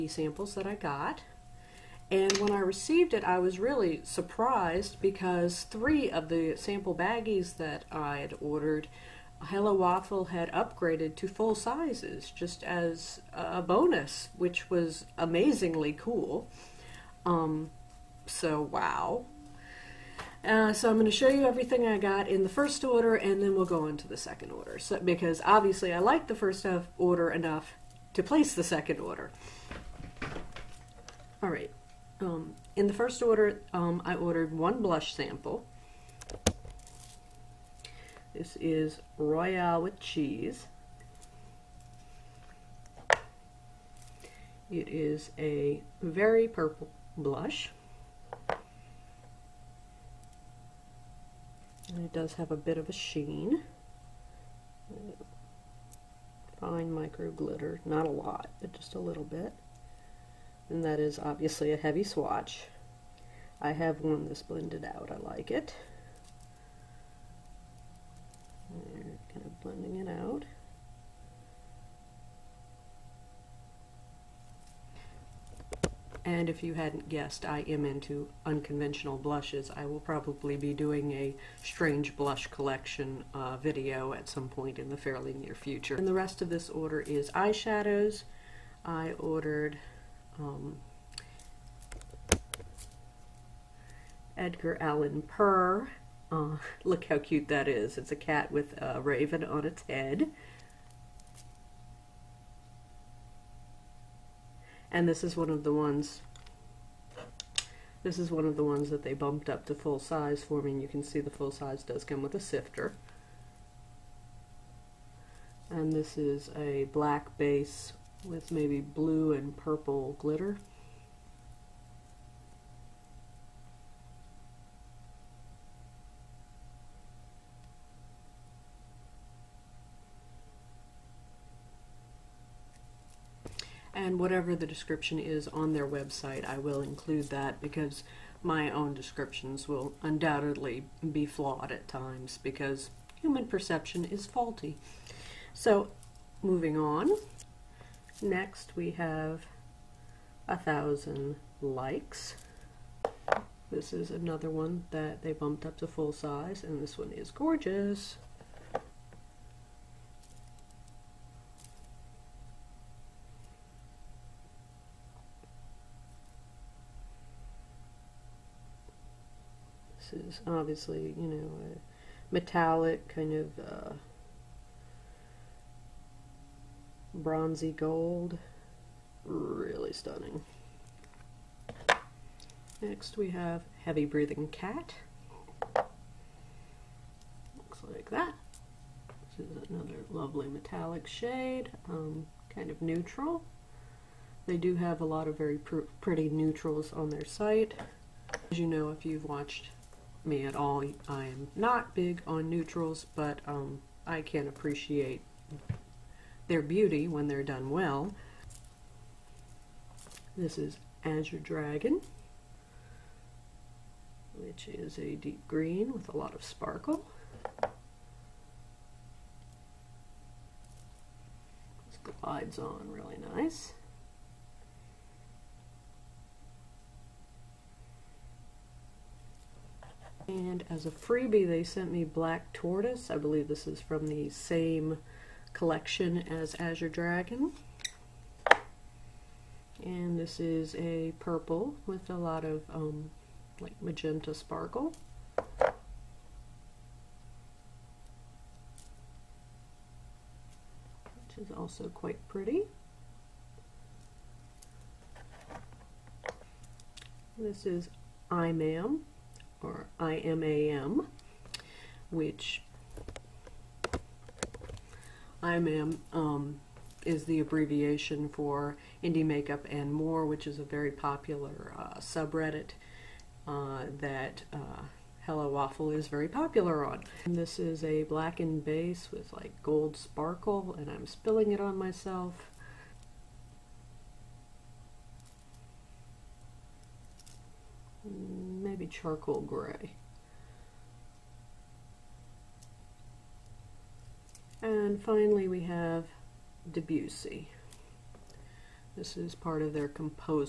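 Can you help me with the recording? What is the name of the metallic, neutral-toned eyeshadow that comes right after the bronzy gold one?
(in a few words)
Heavy Breathing Cat.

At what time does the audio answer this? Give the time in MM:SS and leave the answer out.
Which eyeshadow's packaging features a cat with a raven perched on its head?
01:34.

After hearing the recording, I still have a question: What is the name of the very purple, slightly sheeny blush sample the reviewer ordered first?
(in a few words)
Royale with cheese.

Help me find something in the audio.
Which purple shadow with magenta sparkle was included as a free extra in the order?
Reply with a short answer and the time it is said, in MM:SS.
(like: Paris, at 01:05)
Black Tortoise, at 03:52.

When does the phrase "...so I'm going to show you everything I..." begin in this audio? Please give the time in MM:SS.
00:20.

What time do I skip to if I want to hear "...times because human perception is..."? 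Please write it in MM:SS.
02:21.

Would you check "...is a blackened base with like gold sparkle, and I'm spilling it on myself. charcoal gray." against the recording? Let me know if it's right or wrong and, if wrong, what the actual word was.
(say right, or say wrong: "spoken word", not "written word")
right.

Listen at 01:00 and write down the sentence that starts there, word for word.
And that is obviously a heavy swatch.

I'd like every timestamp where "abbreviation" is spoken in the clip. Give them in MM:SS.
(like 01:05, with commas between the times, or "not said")
04:27.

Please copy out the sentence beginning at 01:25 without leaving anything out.
And the rest of this order is eyeshadows.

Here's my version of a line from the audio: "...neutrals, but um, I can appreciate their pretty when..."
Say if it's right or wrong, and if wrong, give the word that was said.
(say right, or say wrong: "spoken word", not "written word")
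wrong: "beauty", not "pretty".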